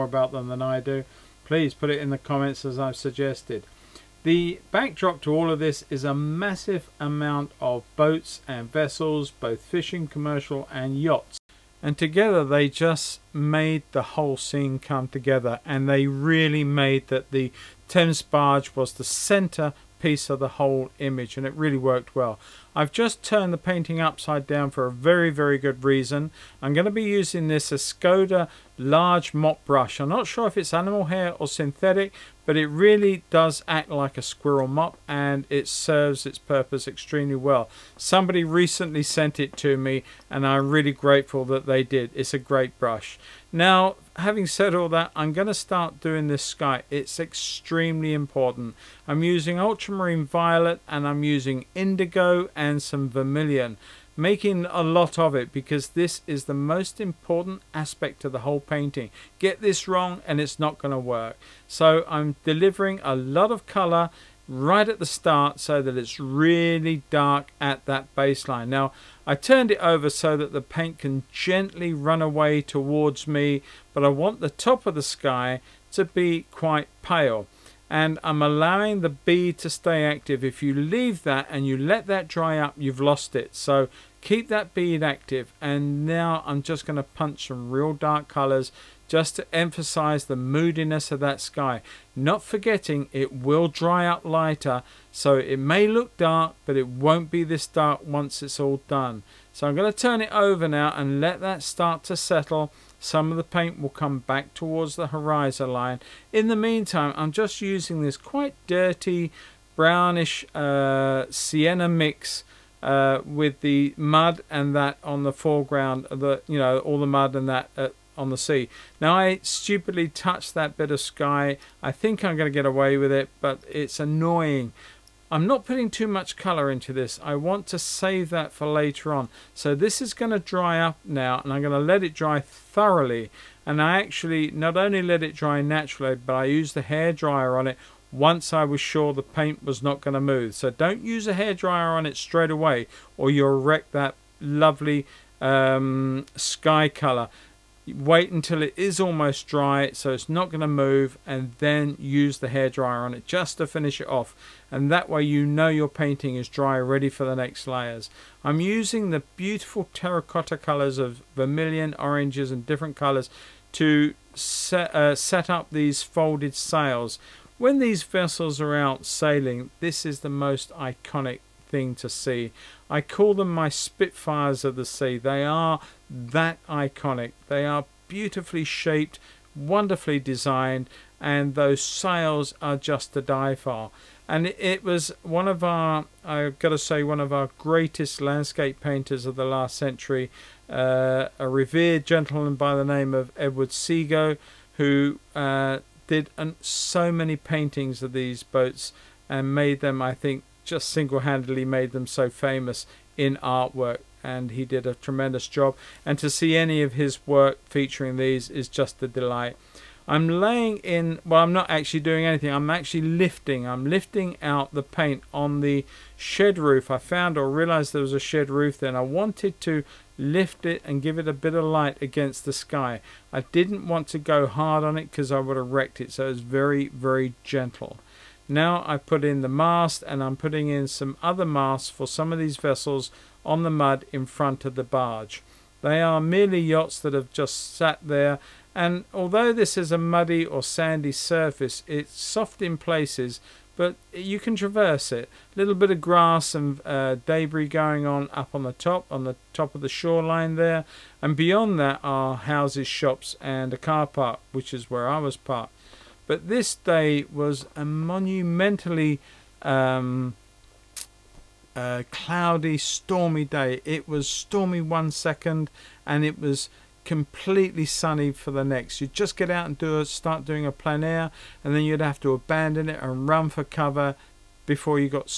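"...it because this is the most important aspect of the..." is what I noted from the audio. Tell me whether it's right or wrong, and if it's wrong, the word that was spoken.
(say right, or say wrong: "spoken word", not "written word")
right.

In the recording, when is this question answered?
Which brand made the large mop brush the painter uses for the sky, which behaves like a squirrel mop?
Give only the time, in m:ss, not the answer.
0:27.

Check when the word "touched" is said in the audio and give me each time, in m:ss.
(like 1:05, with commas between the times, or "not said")
2:00.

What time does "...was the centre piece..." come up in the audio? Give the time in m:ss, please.
0:18.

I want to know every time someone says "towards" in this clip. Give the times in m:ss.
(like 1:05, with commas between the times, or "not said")
1:12, 1:44.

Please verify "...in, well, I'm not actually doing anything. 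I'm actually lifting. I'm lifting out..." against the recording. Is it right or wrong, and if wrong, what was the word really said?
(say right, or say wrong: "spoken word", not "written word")
right.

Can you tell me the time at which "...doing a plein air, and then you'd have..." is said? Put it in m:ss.
4:30.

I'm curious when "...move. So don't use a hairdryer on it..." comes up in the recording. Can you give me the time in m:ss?
2:20.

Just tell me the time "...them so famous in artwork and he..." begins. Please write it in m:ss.
3:21.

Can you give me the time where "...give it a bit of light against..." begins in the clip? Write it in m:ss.
3:41.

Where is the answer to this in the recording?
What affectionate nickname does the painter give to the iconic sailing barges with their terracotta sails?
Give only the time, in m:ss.
2:53.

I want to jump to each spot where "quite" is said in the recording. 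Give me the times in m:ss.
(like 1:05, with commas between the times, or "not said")
1:16, 1:48.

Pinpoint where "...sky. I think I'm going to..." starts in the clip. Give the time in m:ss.
2:00.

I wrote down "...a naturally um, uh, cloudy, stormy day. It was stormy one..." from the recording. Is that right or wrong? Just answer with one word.
wrong.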